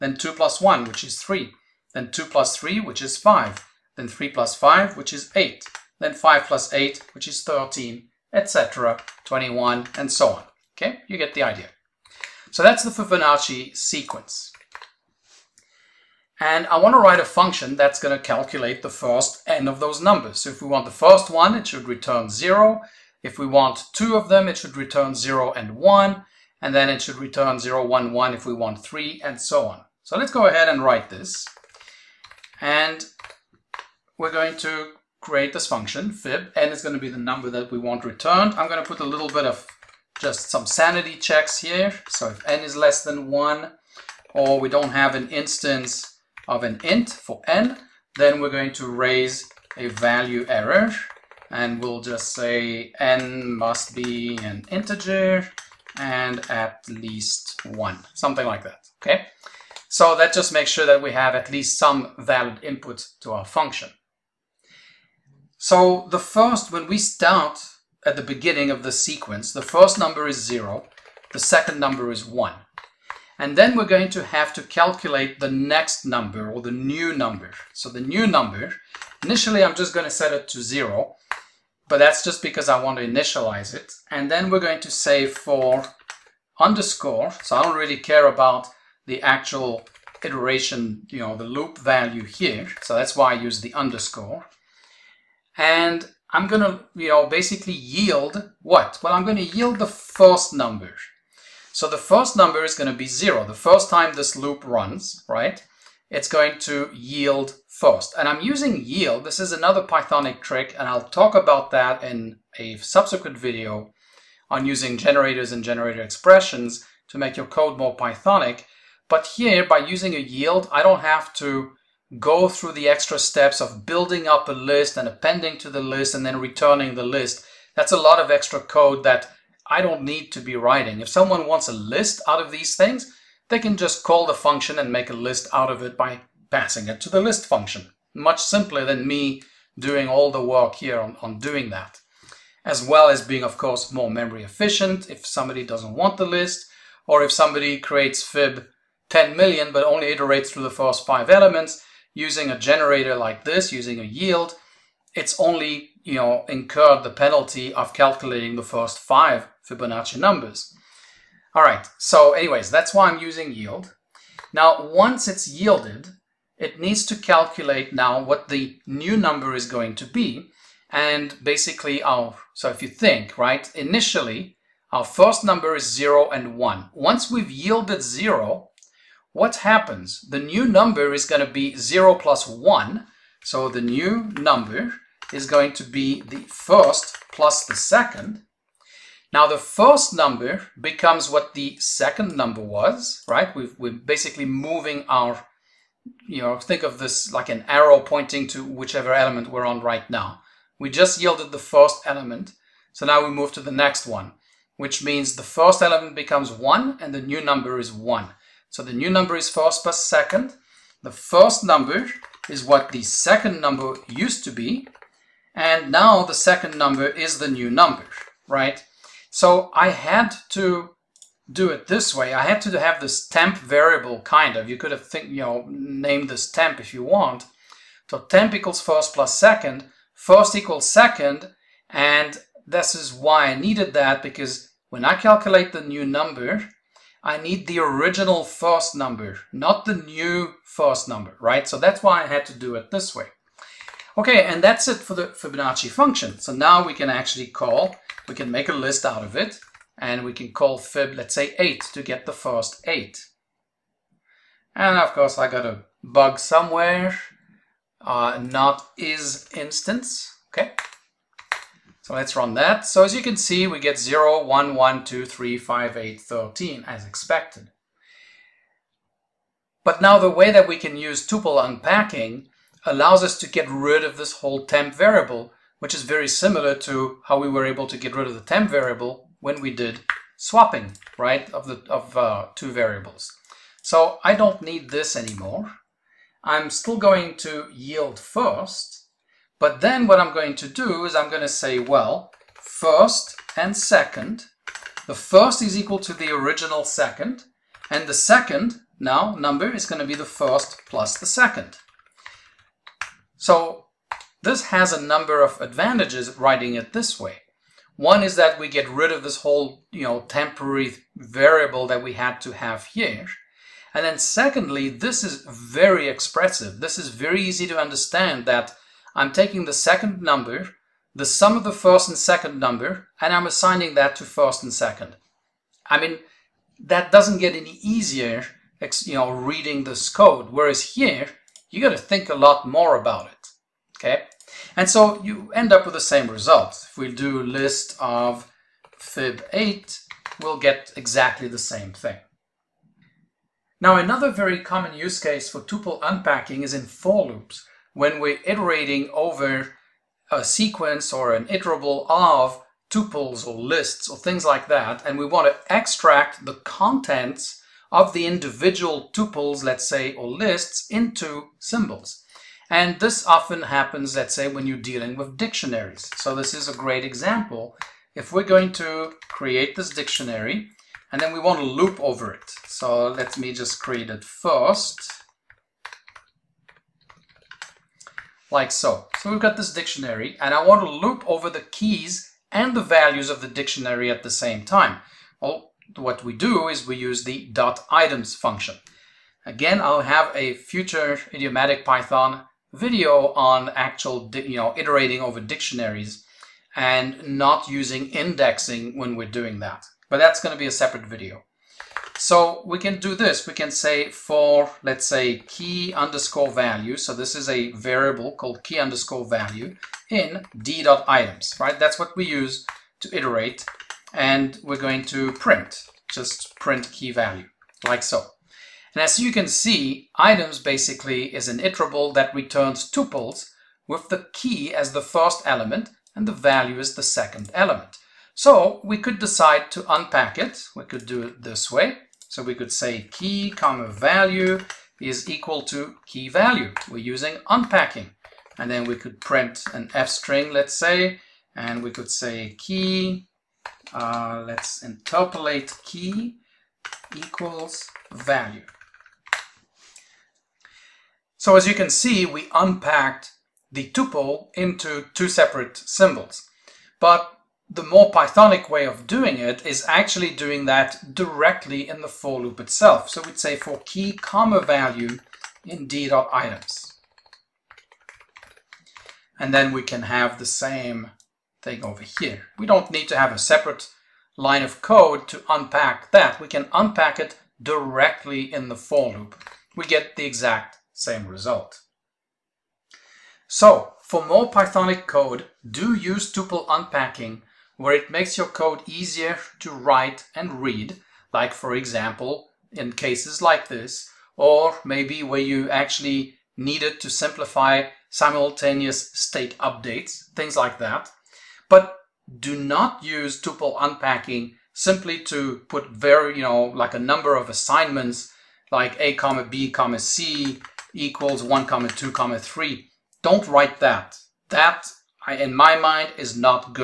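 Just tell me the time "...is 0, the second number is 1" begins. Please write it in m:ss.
1:10.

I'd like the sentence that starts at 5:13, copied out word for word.
And then secondly, this is very expressive.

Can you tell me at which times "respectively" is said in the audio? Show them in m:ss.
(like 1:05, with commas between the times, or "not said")
not said.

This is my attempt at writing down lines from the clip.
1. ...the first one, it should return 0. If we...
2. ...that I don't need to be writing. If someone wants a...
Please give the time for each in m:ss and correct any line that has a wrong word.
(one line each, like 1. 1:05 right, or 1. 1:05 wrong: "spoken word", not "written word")
1. 0:20 right
2. 2:09 right.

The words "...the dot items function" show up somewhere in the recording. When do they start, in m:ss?
6:27.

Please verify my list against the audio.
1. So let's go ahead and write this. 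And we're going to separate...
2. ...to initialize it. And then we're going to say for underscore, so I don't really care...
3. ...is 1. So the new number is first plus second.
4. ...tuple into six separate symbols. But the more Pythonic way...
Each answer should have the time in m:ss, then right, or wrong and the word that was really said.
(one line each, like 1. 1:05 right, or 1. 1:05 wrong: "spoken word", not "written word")
1. 0:30 wrong: "create", not "separate"
2. 1:22 right
3. 3:27 right
4. 7:33 wrong: "two", not "six".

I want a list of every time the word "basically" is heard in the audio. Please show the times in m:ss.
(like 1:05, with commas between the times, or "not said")
1:37, 2:51, 3:13, 7:00.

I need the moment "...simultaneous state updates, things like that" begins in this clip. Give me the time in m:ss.
8:18.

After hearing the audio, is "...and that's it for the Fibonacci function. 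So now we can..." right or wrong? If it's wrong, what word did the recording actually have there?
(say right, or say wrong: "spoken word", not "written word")
right.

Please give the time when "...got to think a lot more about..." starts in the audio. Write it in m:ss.
5:31.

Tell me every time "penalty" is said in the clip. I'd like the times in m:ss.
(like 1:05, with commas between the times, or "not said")
2:37.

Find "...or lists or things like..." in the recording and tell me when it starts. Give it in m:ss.
5:53.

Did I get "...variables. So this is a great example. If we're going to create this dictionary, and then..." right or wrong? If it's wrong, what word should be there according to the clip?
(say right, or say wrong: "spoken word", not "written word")
wrong: "dictionaries", not "variables".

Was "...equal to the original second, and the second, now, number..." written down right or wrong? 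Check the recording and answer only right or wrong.
right.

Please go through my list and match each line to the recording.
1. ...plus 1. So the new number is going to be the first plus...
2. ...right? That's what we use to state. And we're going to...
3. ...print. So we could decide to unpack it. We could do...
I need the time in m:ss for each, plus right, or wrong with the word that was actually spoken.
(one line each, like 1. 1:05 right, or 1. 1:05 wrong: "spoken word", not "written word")
1. 3:02 right
2. 6:51 wrong: "iterate", not "state"
3. 7:07 wrong: "element", not "print".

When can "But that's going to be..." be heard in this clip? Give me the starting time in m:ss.
6:40.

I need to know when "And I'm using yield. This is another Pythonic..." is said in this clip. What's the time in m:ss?
1:48.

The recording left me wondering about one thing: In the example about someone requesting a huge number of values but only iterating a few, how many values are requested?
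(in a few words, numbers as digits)
10 million.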